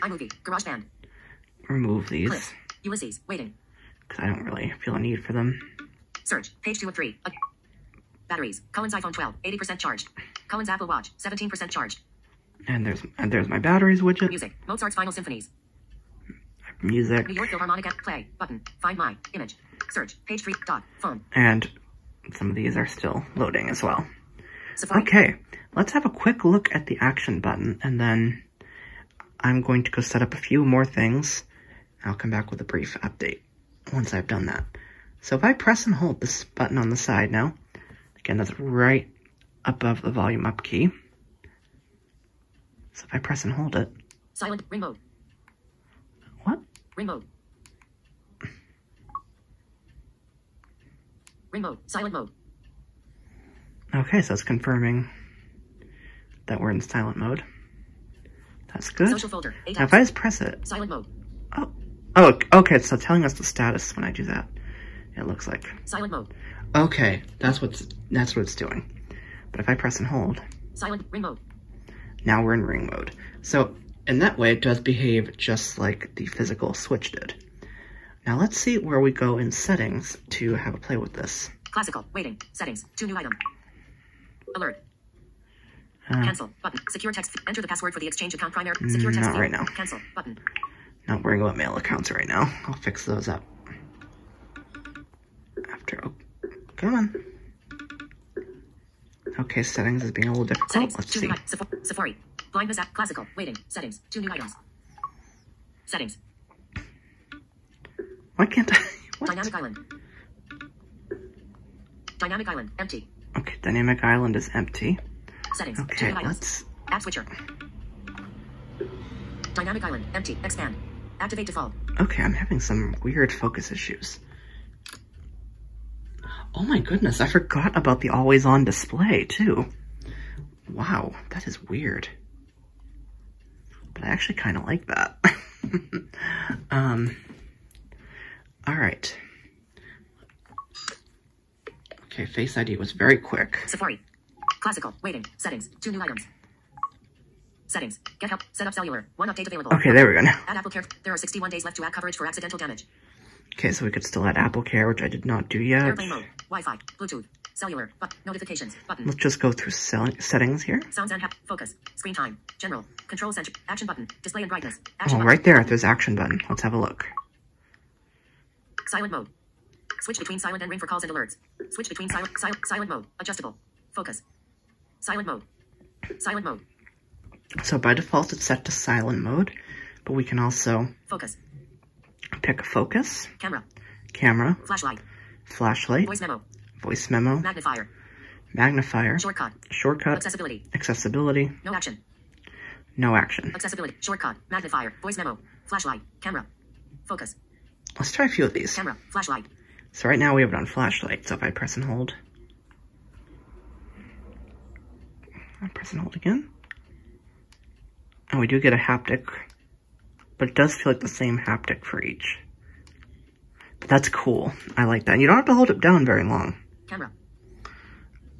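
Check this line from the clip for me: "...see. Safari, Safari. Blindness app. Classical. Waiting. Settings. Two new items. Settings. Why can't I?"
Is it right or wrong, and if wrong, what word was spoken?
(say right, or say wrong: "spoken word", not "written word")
right.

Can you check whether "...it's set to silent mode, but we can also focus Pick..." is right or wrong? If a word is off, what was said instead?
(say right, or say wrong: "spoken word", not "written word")
right.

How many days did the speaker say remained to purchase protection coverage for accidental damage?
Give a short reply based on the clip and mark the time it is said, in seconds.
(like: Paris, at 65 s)
61, at 151 s.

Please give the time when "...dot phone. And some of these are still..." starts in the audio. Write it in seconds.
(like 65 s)
20 s.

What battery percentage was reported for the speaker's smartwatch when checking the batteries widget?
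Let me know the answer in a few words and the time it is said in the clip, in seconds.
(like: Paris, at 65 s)
17%, at 11 s.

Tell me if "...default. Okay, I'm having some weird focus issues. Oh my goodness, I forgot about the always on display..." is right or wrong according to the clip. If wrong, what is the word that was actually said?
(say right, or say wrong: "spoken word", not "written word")
right.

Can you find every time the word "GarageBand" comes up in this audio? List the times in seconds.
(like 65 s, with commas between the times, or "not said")
0 s.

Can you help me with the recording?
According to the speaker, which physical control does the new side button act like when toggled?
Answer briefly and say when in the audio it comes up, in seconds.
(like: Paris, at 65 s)
The physical switch, at 76 s.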